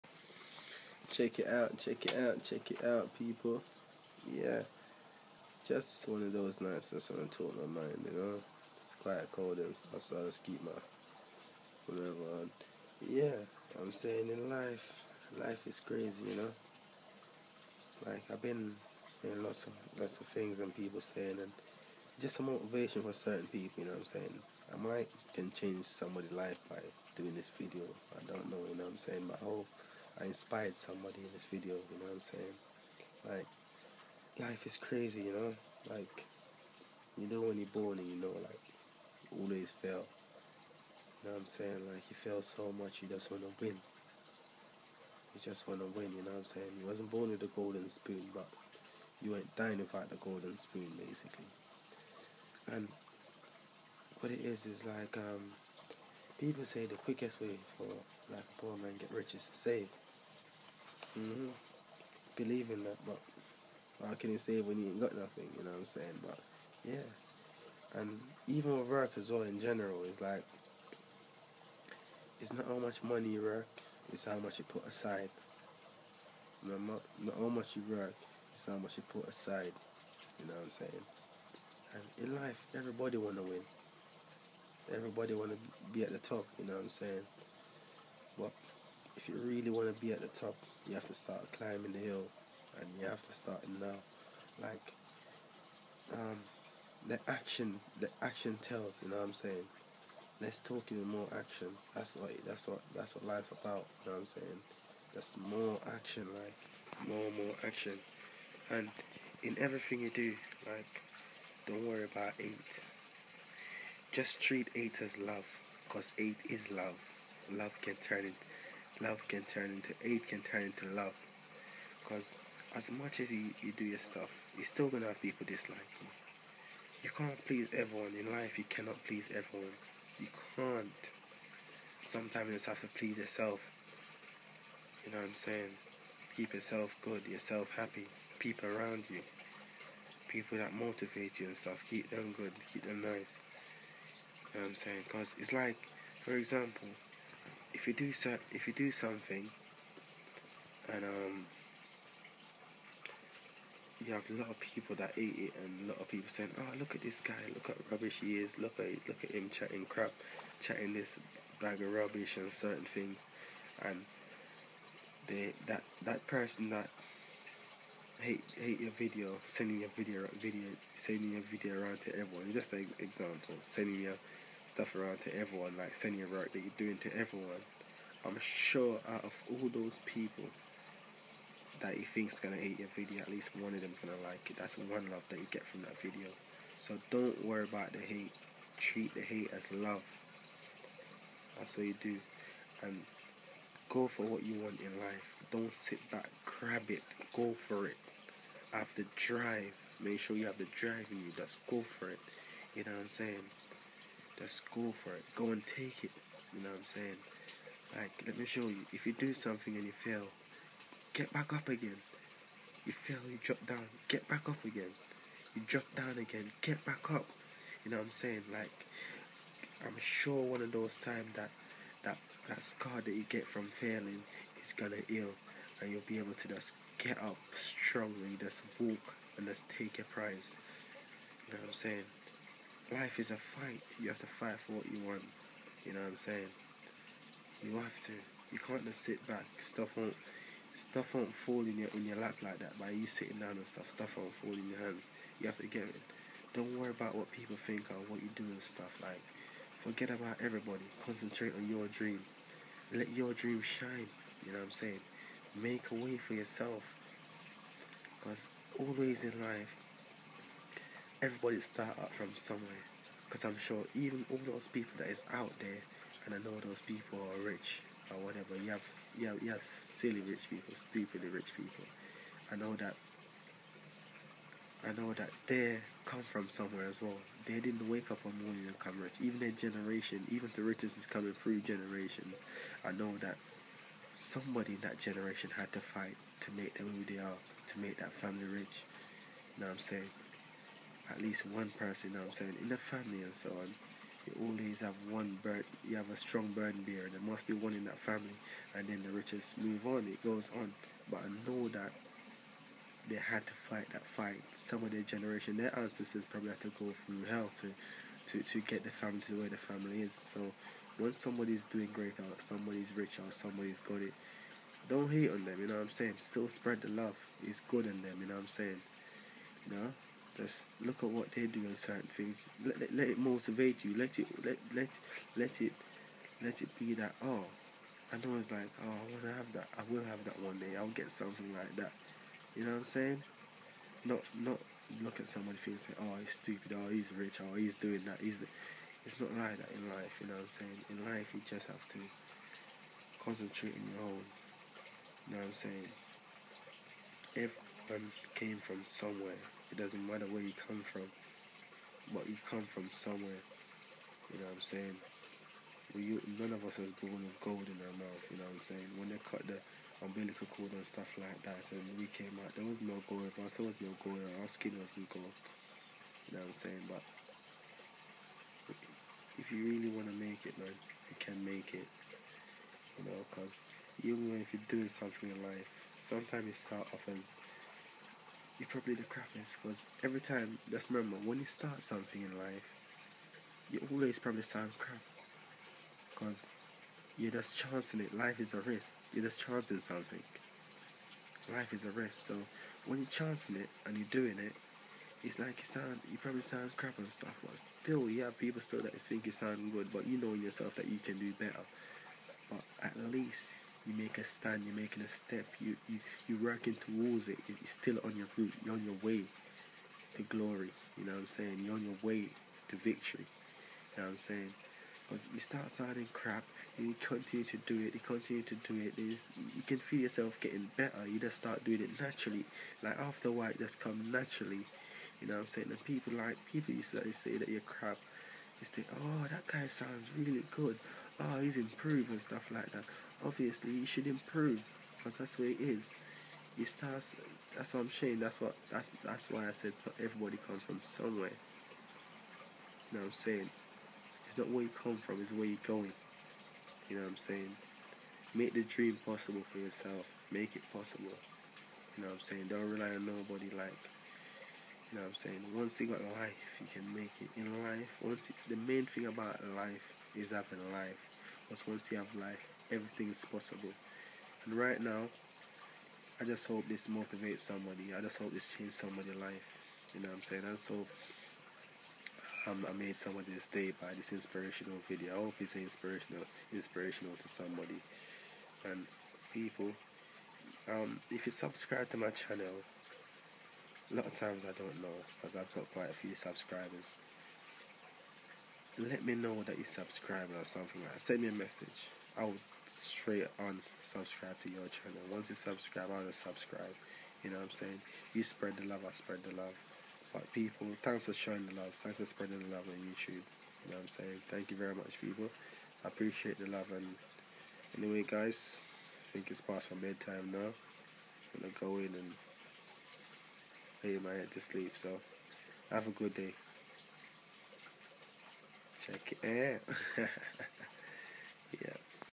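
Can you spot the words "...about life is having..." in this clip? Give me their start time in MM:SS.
07:39.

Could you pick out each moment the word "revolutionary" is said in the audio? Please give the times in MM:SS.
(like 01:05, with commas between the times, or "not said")
not said.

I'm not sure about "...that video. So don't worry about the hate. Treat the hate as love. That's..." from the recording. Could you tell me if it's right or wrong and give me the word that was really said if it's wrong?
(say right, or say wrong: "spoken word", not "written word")
right.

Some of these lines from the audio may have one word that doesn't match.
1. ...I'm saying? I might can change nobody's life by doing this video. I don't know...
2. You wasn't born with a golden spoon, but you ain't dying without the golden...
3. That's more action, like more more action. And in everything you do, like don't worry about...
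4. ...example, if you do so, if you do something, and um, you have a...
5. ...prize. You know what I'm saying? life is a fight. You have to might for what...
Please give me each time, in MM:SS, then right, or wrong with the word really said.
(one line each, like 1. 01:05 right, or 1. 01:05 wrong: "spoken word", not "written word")
1. 00:23 wrong: "somebody", not "nobody"
2. 00:46 right
3. 01:45 right
4. 02:26 right
5. 03:50 wrong: "fight", not "might".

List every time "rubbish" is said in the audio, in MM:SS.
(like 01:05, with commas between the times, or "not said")
02:37, 02:41.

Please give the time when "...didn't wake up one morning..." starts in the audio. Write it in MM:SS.
04:37.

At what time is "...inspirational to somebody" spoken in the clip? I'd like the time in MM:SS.
07:56.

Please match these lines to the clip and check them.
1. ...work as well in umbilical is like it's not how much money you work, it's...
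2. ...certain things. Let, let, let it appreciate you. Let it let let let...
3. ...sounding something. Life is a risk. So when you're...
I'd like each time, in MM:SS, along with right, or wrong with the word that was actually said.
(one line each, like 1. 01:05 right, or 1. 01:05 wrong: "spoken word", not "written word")
1. 01:08 wrong: "general", not "umbilical"
2. 05:21 wrong: "motivate", not "appreciate"
3. 06:29 wrong: "chancing", not "sounding".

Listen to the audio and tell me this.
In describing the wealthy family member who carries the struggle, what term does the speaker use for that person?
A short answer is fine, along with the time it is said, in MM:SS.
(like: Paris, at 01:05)
burden bearer, at 04:56.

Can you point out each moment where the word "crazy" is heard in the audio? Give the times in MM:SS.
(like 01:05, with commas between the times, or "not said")
00:15, 00:34.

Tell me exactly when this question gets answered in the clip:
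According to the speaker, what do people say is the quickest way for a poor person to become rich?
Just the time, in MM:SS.
00:59.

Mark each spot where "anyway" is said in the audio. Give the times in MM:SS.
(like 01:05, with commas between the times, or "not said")
08:27.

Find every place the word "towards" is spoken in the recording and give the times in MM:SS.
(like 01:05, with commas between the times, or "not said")
06:46.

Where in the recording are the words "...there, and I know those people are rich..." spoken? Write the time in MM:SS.
04:25.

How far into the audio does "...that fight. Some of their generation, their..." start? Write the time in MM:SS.
05:03.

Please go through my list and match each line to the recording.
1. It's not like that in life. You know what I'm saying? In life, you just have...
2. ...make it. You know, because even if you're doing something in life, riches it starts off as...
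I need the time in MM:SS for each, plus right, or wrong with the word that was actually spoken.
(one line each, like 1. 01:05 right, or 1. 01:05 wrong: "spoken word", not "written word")
1. 05:39 right
2. 06:11 wrong: "sometimes", not "riches".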